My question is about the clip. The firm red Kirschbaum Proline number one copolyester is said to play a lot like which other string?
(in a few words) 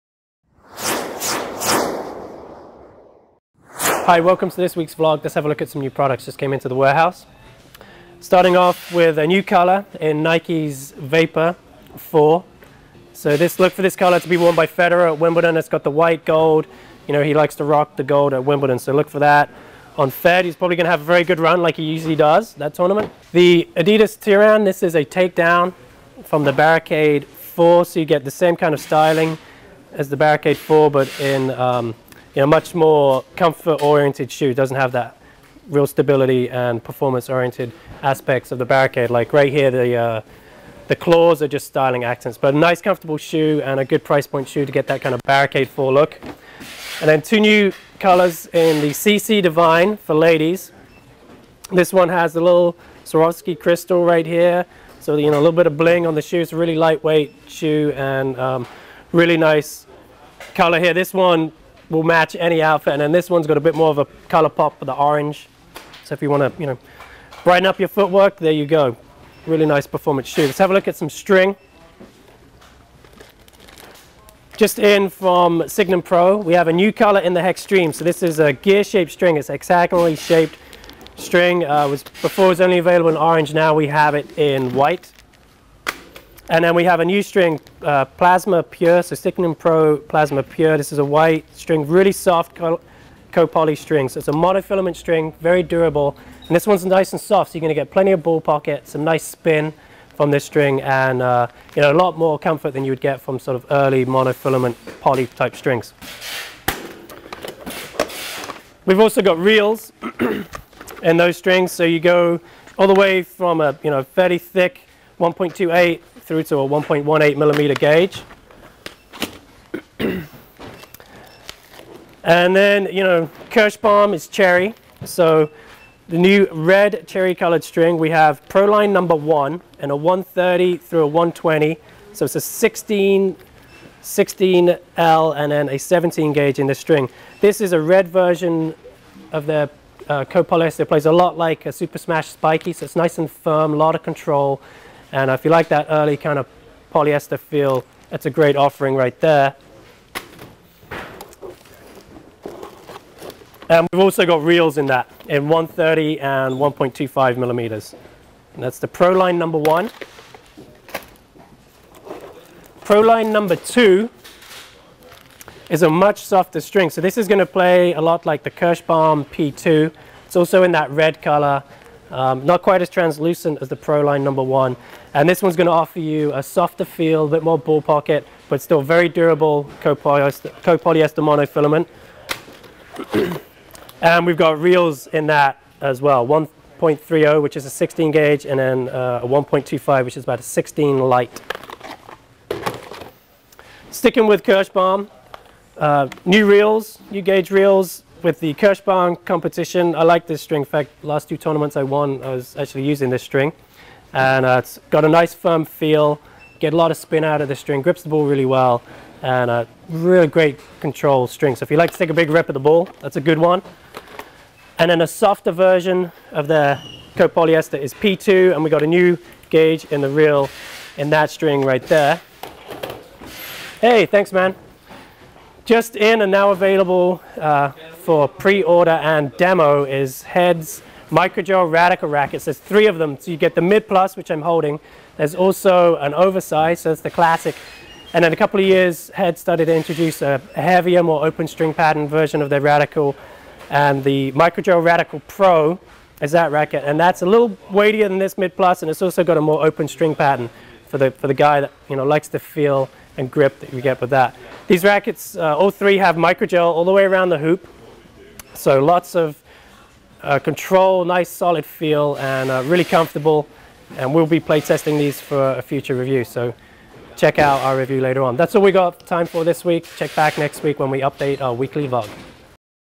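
Super Smash Spiky.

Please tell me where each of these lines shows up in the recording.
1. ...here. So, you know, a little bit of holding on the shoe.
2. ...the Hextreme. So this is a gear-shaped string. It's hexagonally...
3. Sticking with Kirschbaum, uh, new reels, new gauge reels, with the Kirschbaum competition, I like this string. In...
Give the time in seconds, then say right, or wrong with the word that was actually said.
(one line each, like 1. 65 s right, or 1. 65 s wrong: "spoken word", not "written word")
1. 54 s wrong: "bling", not "holding"
2. 77 s right
3. 193 s right.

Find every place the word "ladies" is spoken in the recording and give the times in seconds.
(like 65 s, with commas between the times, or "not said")
50 s.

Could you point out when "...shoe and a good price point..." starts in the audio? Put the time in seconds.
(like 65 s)
43 s.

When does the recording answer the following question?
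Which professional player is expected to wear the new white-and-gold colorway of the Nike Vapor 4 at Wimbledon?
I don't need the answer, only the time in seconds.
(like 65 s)
14 s.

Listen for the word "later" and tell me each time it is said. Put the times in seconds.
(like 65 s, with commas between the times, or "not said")
268 s.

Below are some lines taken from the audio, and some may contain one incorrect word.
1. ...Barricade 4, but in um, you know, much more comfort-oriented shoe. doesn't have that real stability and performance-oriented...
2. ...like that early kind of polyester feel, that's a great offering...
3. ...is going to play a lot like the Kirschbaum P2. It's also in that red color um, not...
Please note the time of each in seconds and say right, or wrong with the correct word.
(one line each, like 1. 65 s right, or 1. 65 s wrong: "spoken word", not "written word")
1. 30 s right
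2. 145 s right
3. 167 s right.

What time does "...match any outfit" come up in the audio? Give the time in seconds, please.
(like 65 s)
62 s.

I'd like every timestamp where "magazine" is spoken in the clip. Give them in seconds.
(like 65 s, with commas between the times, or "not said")
not said.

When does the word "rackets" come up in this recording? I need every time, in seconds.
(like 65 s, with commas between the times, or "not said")
232 s, 246 s, 254 s.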